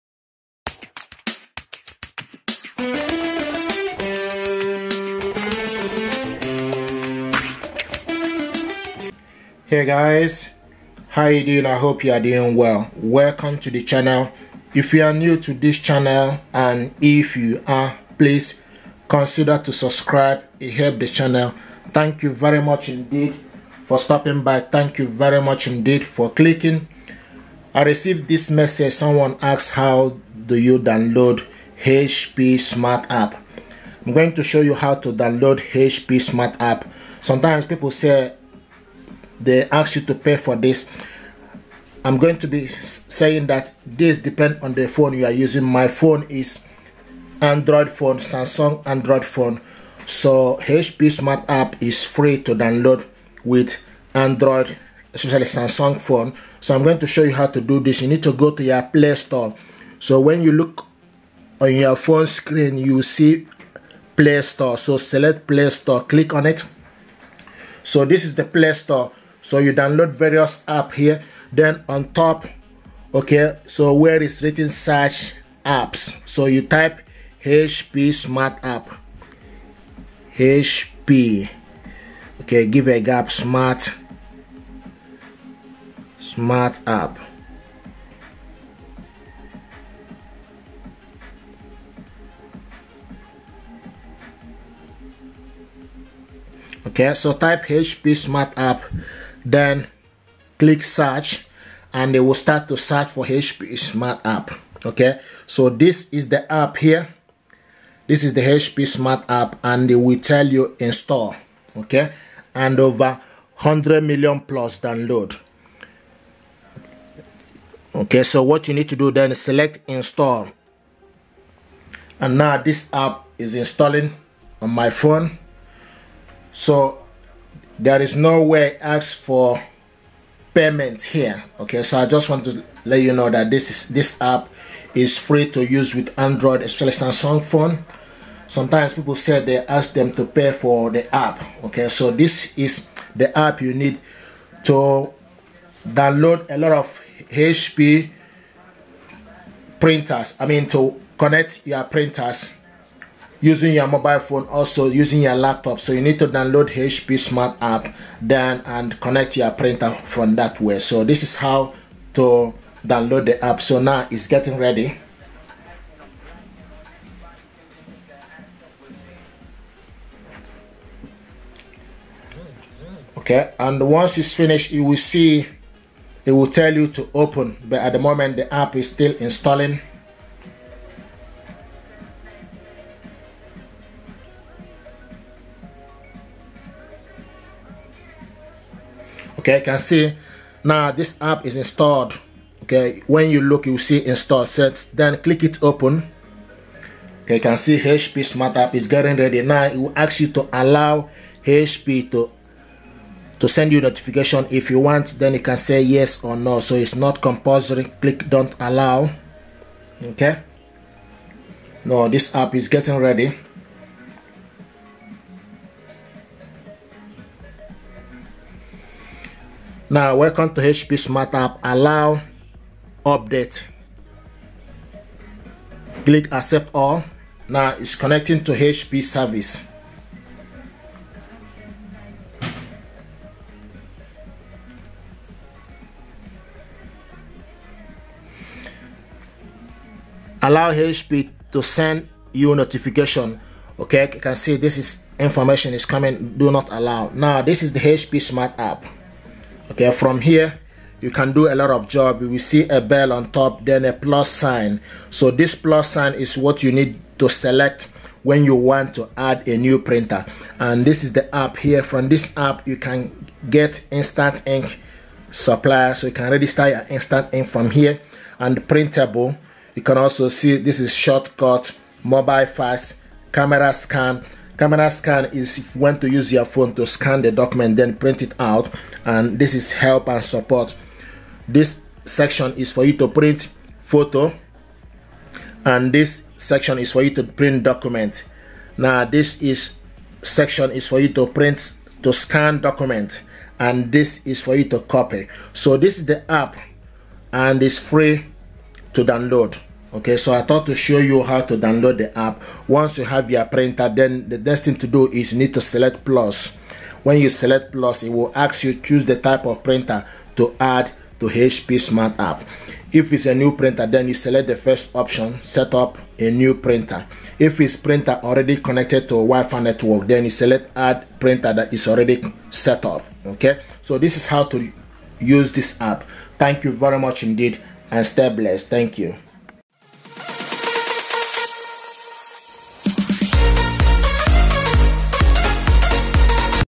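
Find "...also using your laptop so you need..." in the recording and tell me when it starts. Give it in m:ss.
2:34.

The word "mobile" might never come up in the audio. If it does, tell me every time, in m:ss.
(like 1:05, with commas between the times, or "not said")
2:33, 4:32.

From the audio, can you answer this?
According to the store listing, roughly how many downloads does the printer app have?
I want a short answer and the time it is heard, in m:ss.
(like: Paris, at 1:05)
100 million plus, at 1:53.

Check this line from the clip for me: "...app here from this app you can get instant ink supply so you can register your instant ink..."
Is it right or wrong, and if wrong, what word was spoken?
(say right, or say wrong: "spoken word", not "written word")
right.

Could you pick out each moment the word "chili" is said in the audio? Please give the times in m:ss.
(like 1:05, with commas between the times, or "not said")
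not said.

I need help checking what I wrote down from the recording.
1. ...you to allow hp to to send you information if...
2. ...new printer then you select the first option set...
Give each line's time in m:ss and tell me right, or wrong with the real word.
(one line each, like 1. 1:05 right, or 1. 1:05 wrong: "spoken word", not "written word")
1. 3:20 wrong: "notification", not "information"
2. 5:13 right.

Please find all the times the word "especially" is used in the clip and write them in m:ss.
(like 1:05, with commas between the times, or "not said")
0:55, 2:16.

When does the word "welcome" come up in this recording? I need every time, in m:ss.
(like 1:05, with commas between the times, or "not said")
0:12, 3:40.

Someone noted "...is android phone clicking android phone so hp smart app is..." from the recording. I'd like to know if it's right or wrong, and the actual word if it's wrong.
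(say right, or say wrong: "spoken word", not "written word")
wrong: "samsung", not "clicking".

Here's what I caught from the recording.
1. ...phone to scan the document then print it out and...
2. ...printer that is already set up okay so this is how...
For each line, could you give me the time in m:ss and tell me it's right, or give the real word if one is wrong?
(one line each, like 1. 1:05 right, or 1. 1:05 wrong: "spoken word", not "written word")
1. 4:36 right
2. 5:21 right.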